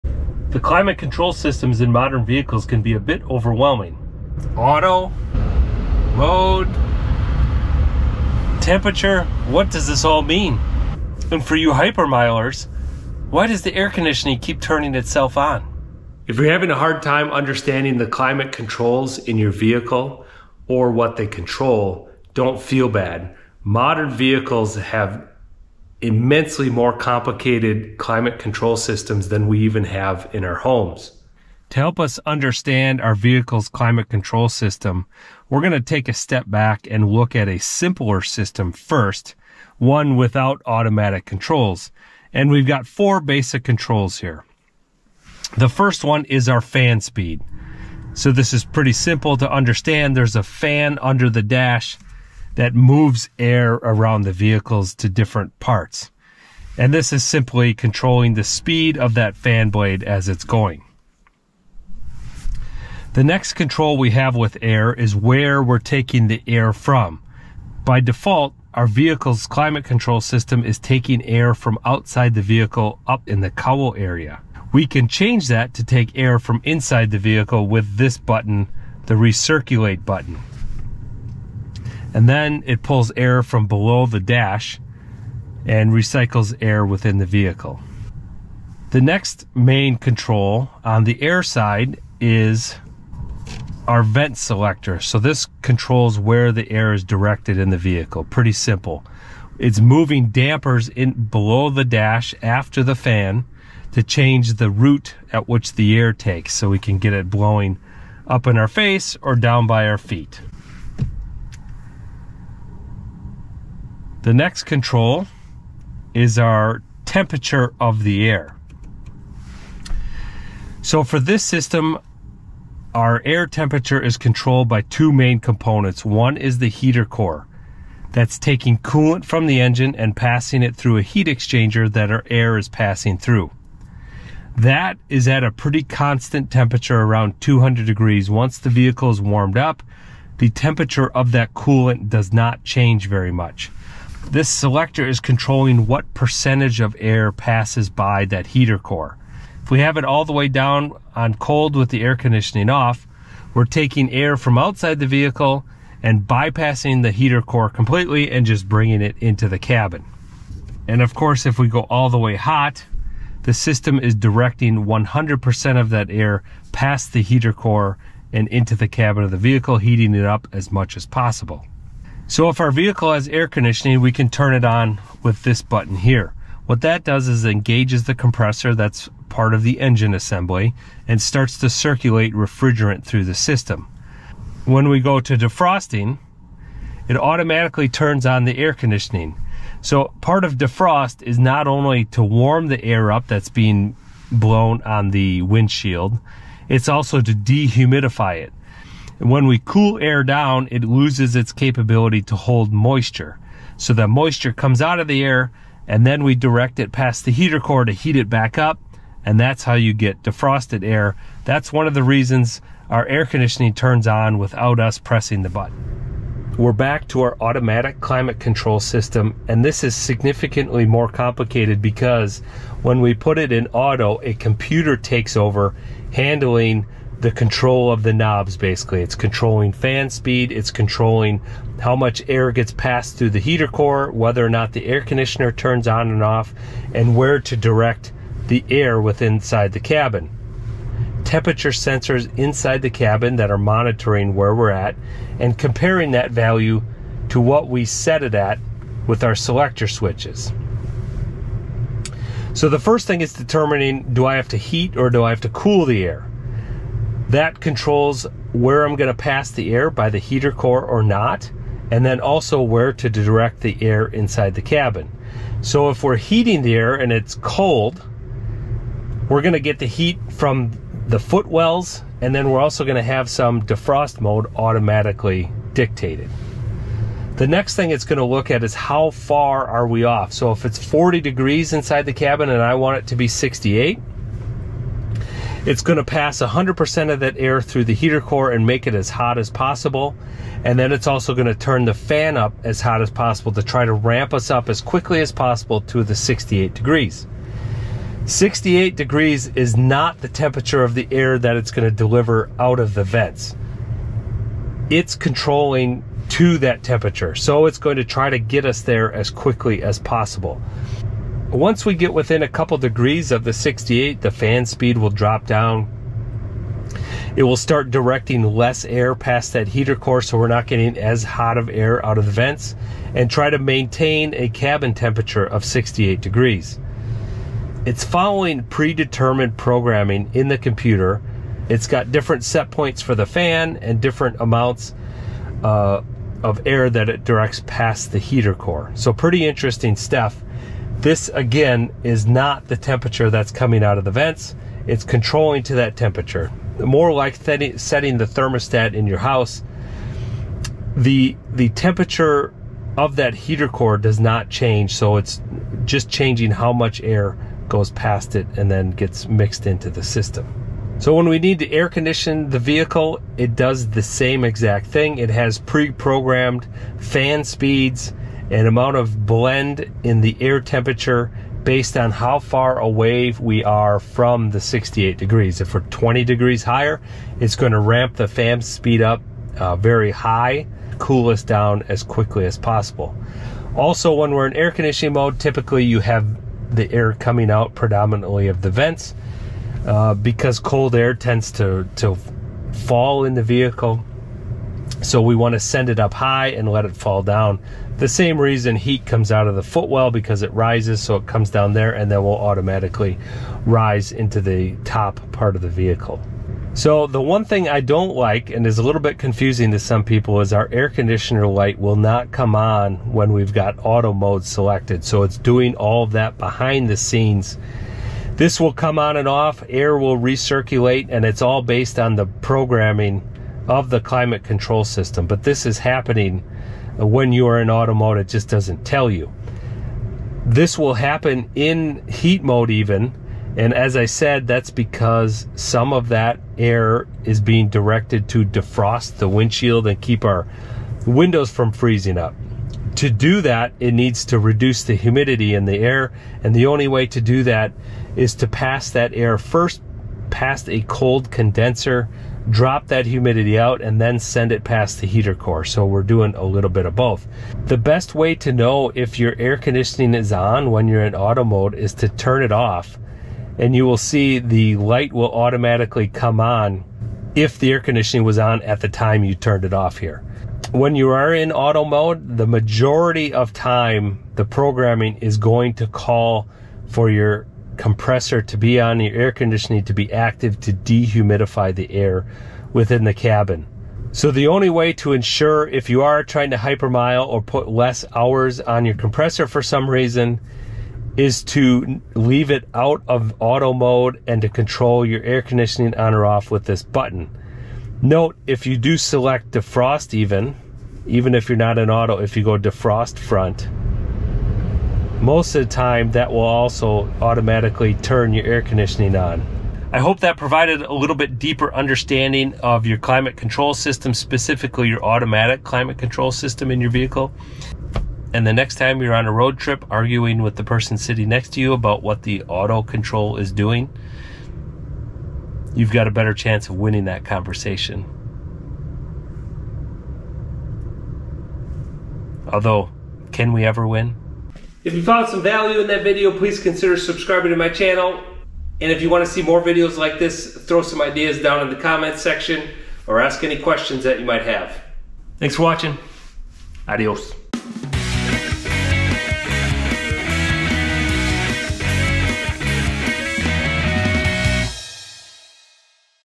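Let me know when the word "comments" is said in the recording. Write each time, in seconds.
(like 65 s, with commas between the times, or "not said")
541 s.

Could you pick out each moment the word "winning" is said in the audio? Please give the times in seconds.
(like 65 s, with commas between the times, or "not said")
526 s.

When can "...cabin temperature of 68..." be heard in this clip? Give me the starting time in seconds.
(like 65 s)
324 s.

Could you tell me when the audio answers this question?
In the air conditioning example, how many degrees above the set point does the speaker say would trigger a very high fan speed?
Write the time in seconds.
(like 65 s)
375 s.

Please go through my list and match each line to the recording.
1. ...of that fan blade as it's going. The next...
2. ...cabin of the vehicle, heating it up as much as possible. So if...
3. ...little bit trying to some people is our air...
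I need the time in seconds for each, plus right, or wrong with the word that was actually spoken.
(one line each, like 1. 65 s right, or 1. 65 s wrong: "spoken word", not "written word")
1. 58 s right
2. 168 s right
3. 408 s wrong: "confusing", not "trying".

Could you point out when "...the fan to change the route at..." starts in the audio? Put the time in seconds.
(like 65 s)
102 s.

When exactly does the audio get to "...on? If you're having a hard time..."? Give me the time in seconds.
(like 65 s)
15 s.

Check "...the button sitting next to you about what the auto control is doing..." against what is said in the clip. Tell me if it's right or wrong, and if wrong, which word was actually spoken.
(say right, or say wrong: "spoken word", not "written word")
wrong: "person", not "button".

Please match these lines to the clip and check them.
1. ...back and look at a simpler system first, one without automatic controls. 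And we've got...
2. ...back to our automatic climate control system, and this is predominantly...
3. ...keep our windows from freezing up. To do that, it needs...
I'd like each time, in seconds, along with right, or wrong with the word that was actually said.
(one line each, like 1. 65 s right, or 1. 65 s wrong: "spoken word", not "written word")
1. 36 s right
2. 216 s wrong: "significantly", not "predominantly"
3. 439 s right.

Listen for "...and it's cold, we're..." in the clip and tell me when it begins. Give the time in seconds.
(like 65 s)
266 s.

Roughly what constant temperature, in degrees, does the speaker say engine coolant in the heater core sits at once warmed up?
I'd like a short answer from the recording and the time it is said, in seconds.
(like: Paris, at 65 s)
200 degrees, at 137 s.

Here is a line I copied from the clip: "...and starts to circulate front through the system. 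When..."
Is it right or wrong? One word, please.
wrong.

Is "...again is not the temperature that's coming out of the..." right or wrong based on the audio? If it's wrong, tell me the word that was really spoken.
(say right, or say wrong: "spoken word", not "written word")
right.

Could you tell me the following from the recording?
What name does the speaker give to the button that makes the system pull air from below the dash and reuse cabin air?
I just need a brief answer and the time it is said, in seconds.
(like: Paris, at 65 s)
Recirculate button, at 79 s.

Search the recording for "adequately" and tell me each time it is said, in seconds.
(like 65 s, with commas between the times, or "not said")
not said.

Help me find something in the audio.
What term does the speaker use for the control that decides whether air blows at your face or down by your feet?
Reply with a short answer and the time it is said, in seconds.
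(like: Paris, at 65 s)
Vent selector, at 94 s.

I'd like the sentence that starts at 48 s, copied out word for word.
So this is pretty simple to understand.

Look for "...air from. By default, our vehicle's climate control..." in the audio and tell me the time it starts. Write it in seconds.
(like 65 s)
66 s.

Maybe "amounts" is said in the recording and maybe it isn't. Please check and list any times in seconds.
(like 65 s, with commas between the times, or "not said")
334 s, 368 s.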